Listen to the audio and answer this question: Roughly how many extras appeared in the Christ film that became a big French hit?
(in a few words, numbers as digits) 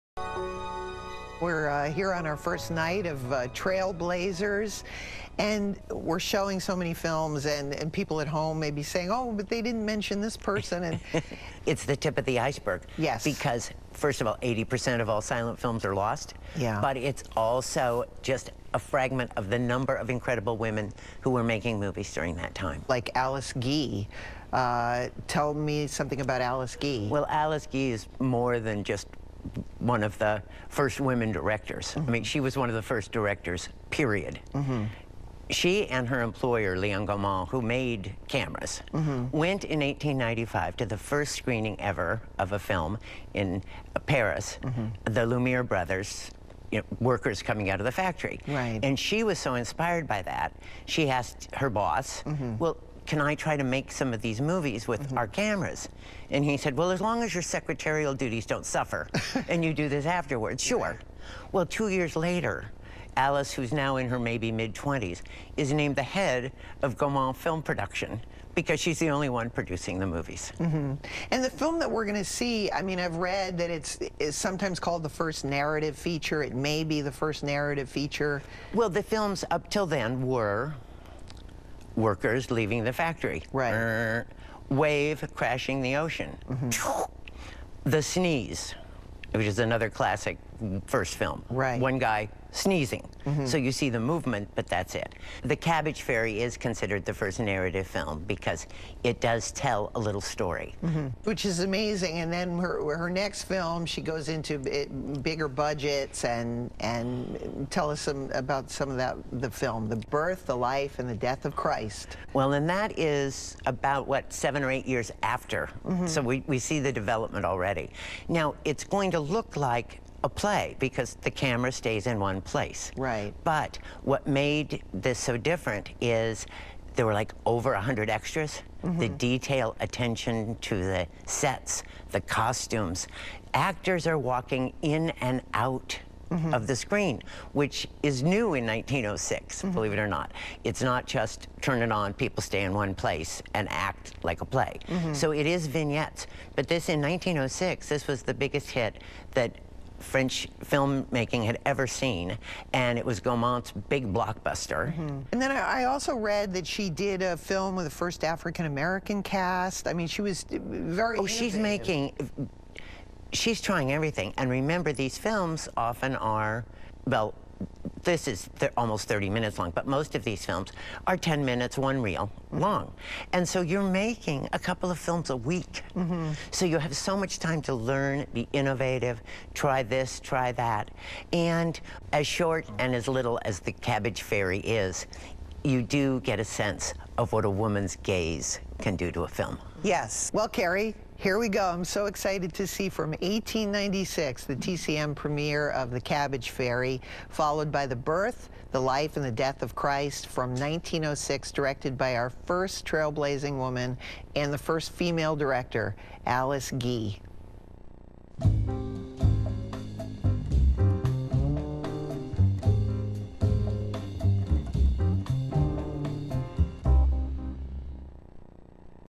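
over 100.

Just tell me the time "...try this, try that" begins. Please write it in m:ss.
2:59.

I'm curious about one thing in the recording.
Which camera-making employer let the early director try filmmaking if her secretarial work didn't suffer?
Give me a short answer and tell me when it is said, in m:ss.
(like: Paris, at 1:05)
Leon Gaumont, at 0:36.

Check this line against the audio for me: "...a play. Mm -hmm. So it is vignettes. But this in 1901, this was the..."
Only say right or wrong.
wrong.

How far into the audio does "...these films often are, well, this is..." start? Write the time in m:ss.
2:44.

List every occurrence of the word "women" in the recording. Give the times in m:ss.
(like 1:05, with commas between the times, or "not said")
0:20, 0:31.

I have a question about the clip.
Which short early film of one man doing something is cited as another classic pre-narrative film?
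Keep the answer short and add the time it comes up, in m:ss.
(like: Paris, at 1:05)
The Sneeze, at 1:27.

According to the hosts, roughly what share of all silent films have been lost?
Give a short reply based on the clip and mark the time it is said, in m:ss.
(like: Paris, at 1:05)
80%, at 0:14.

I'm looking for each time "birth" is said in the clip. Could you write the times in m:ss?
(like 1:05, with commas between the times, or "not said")
1:50, 3:17.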